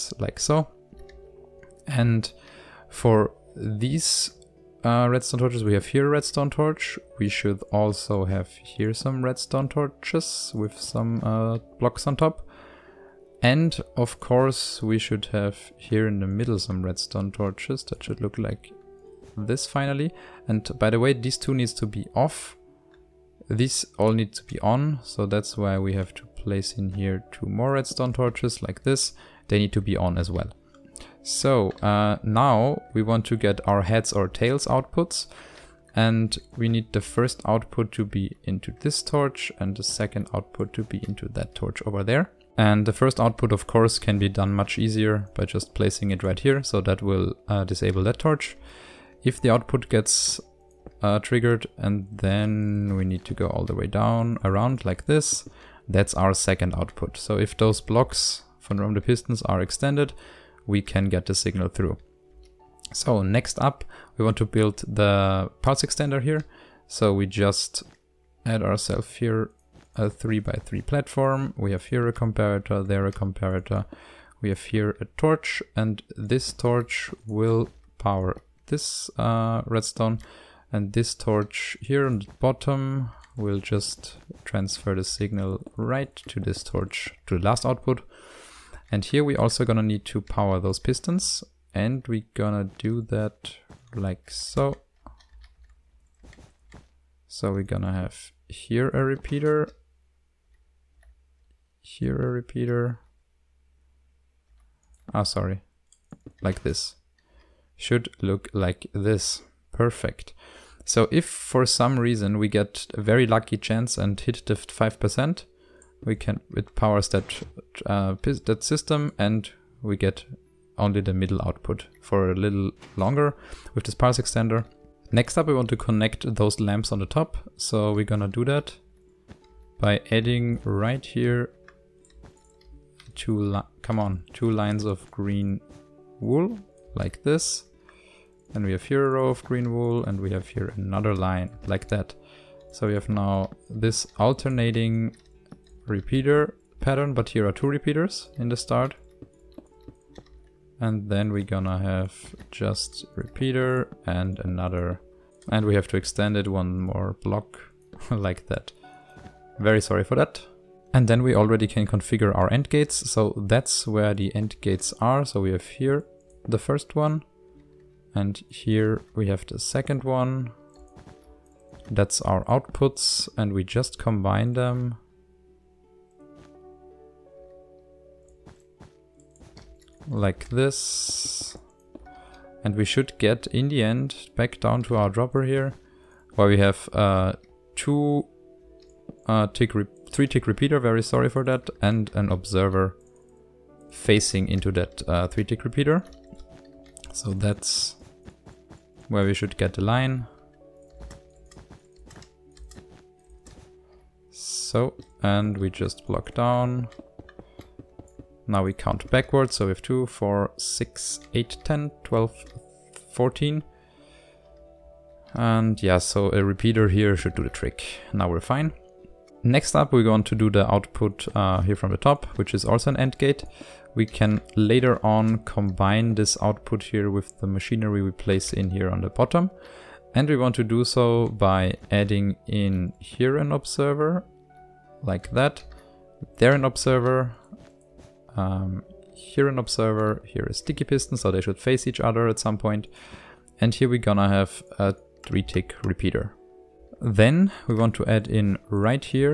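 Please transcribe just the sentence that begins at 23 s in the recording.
These all need to be on, so that's why we have to place in here two more redstone torches like this.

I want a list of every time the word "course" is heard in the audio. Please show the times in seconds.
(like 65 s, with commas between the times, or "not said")
14 s, 43 s.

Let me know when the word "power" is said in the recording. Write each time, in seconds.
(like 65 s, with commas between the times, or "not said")
77 s, 90 s, 116 s.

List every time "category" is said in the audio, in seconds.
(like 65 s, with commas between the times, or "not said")
not said.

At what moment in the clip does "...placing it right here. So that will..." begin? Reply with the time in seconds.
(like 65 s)
45 s.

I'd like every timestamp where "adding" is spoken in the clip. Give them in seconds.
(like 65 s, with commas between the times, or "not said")
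130 s, 231 s.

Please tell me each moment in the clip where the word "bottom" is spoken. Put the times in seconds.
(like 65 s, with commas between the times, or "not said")
82 s, 229 s.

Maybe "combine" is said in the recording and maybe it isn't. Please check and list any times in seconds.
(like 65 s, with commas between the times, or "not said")
173 s, 225 s.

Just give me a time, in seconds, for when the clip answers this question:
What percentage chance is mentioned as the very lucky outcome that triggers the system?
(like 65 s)
114 s.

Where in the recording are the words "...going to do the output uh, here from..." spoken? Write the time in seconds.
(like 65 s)
220 s.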